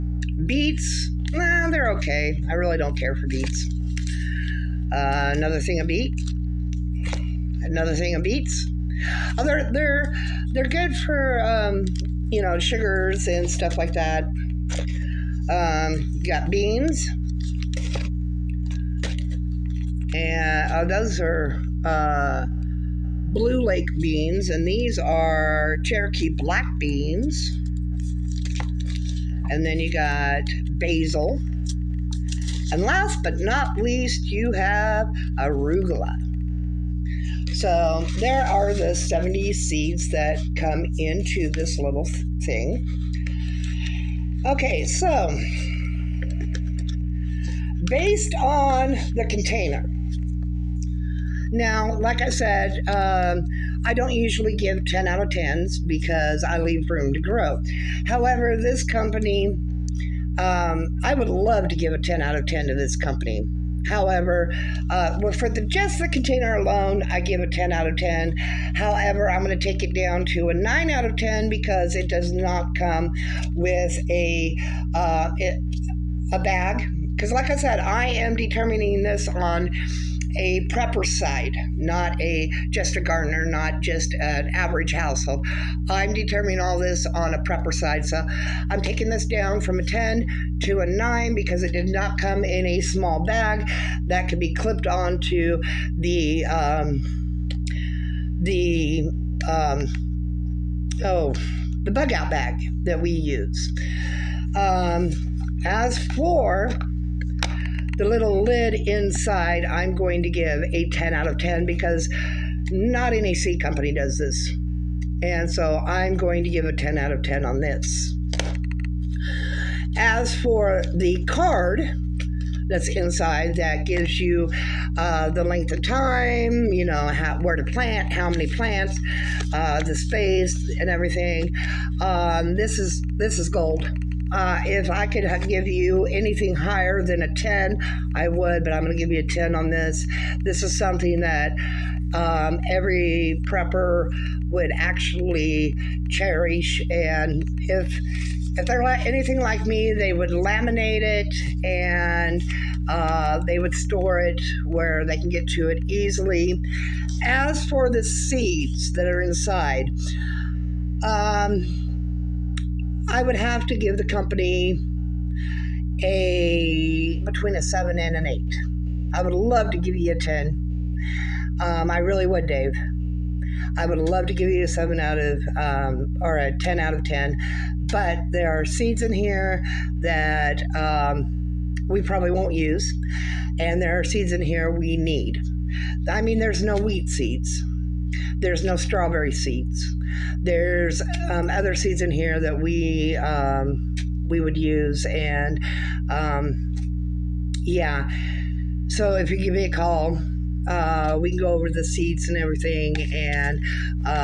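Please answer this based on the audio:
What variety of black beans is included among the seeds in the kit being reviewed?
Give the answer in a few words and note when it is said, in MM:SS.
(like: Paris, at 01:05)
Cherokee, at 00:25.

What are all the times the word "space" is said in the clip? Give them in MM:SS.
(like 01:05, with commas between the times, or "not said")
02:09.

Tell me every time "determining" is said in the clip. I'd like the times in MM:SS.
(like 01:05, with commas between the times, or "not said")
01:18, 01:26.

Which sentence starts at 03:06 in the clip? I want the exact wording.
I mean, there's no wheat seeds.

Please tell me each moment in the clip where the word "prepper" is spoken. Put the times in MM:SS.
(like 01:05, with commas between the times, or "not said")
01:20, 01:27, 02:23.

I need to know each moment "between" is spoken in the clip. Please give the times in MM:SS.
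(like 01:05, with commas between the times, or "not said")
02:47.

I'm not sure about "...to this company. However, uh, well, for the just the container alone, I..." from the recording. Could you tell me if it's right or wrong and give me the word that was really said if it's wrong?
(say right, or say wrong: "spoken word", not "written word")
right.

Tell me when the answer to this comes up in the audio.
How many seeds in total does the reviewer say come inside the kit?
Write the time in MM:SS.
00:38.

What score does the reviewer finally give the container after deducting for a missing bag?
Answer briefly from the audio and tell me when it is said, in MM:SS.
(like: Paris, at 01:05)
9 out of 10, at 01:10.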